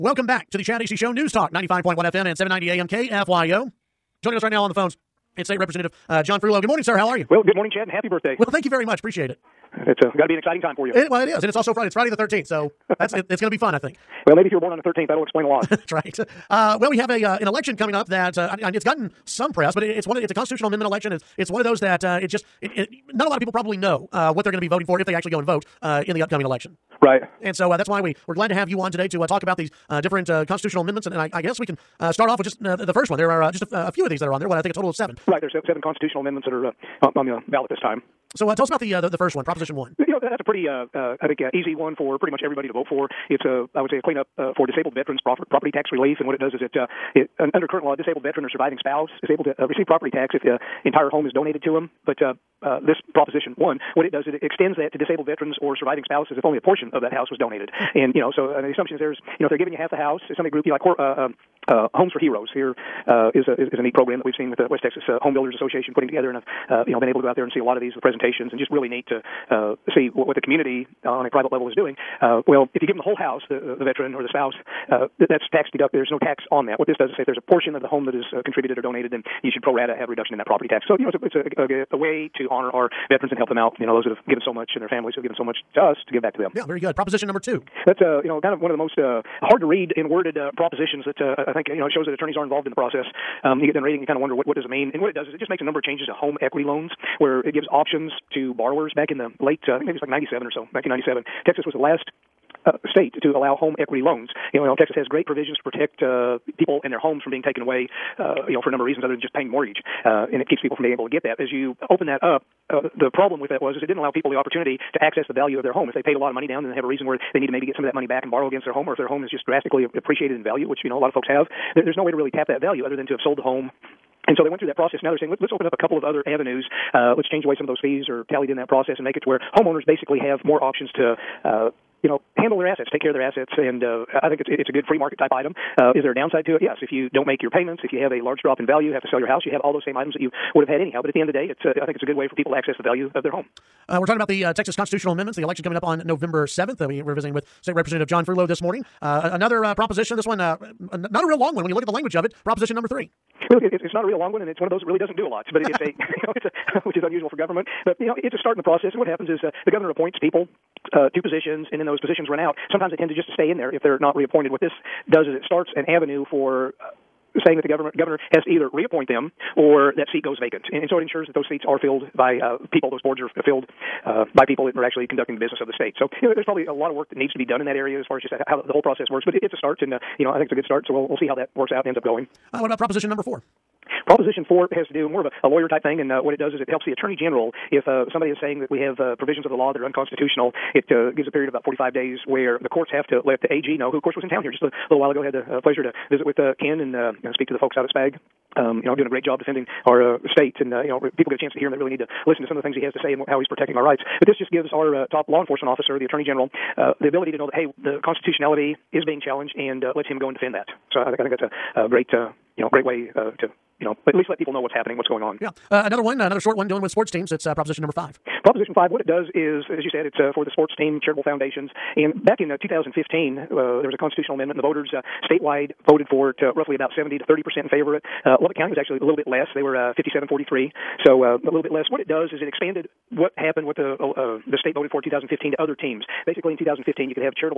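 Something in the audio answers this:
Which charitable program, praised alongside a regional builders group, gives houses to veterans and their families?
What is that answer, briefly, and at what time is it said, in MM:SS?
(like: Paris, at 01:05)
Homes for Heroes, at 01:01.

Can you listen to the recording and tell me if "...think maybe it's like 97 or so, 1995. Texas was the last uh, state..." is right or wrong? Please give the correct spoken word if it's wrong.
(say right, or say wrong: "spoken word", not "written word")
wrong: "1997", not "1995".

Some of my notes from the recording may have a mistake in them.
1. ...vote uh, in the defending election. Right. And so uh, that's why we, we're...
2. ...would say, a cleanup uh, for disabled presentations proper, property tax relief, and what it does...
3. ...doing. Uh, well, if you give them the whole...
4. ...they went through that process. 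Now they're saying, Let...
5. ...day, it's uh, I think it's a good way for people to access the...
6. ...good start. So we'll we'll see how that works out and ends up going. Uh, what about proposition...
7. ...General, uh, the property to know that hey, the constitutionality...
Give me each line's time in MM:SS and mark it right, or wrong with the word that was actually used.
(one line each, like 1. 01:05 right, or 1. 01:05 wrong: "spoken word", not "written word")
1. 00:25 wrong: "upcoming", not "defending"
2. 00:43 wrong: "veterans", not "presentations"
3. 01:11 right
4. 02:04 right
5. 02:21 right
6. 03:00 right
7. 03:26 wrong: "ability", not "property".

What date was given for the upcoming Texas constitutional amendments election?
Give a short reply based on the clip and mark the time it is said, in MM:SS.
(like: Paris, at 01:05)
November 7th, at 02:26.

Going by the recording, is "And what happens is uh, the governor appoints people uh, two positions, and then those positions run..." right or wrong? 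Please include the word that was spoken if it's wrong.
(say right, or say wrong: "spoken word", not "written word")
right.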